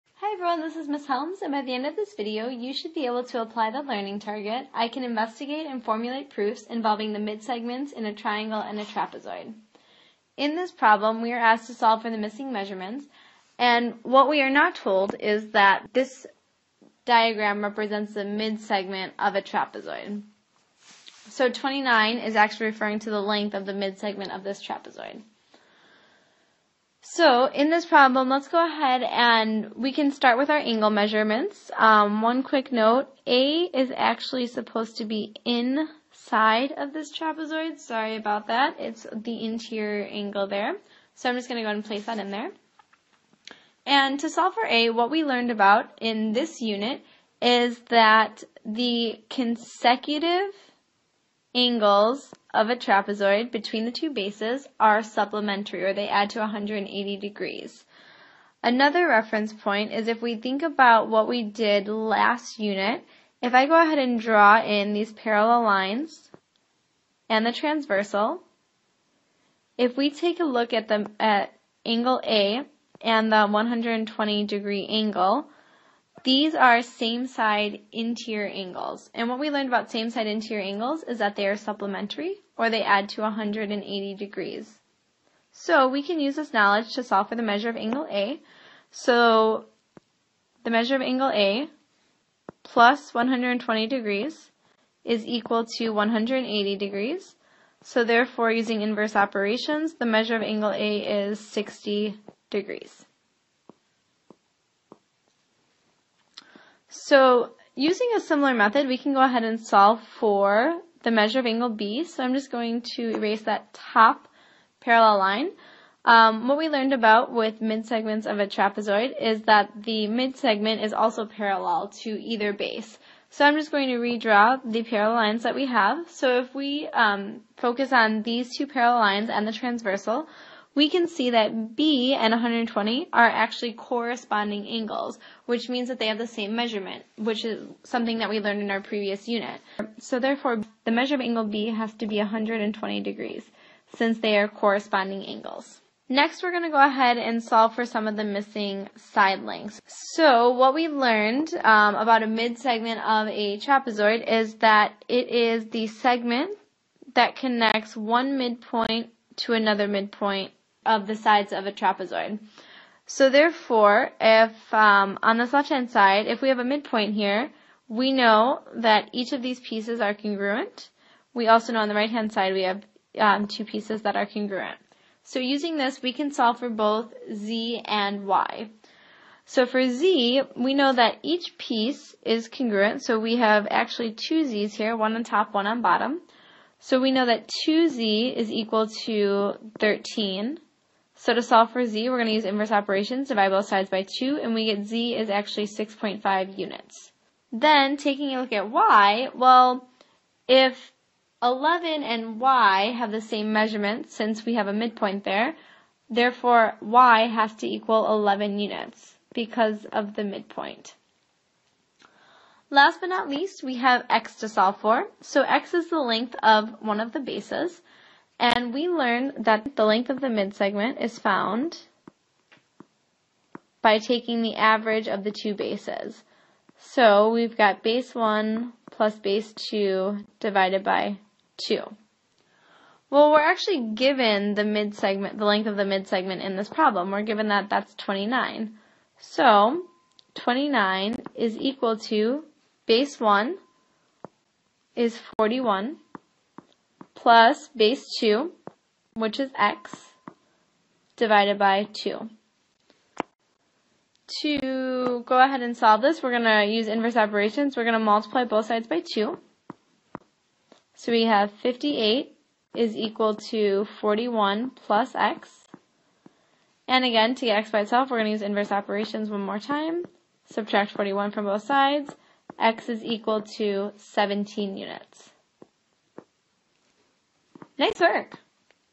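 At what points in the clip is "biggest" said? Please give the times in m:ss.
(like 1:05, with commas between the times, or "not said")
not said.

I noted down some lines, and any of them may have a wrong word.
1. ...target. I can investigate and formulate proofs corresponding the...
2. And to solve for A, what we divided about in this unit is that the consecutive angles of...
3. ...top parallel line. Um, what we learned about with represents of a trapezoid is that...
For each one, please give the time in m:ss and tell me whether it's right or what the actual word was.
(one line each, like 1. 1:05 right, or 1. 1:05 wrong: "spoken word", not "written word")
1. 0:04 wrong: "involving", not "corresponding"
2. 0:43 wrong: "learned", not "divided"
3. 1:53 wrong: "midsegments", not "represents".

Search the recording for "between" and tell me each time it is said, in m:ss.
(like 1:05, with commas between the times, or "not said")
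0:53.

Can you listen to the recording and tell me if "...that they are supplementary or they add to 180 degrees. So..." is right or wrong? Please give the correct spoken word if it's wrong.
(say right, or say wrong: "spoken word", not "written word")
right.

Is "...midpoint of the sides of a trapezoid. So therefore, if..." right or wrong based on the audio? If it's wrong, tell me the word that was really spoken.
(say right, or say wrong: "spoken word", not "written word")
right.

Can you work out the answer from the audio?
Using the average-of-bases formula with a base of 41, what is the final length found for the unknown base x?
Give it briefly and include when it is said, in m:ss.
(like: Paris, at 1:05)
17 units, at 4:33.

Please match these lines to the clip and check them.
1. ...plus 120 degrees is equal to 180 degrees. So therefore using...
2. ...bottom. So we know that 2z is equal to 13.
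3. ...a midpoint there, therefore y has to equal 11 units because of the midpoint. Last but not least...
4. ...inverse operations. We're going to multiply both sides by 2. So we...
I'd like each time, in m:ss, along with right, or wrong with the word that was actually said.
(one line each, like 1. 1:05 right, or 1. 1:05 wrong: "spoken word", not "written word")
1. 1:32 right
2. 3:05 right
3. 3:24 right
4. 4:16 right.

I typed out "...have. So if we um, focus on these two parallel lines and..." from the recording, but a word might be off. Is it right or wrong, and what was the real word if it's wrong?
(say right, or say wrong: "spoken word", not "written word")
right.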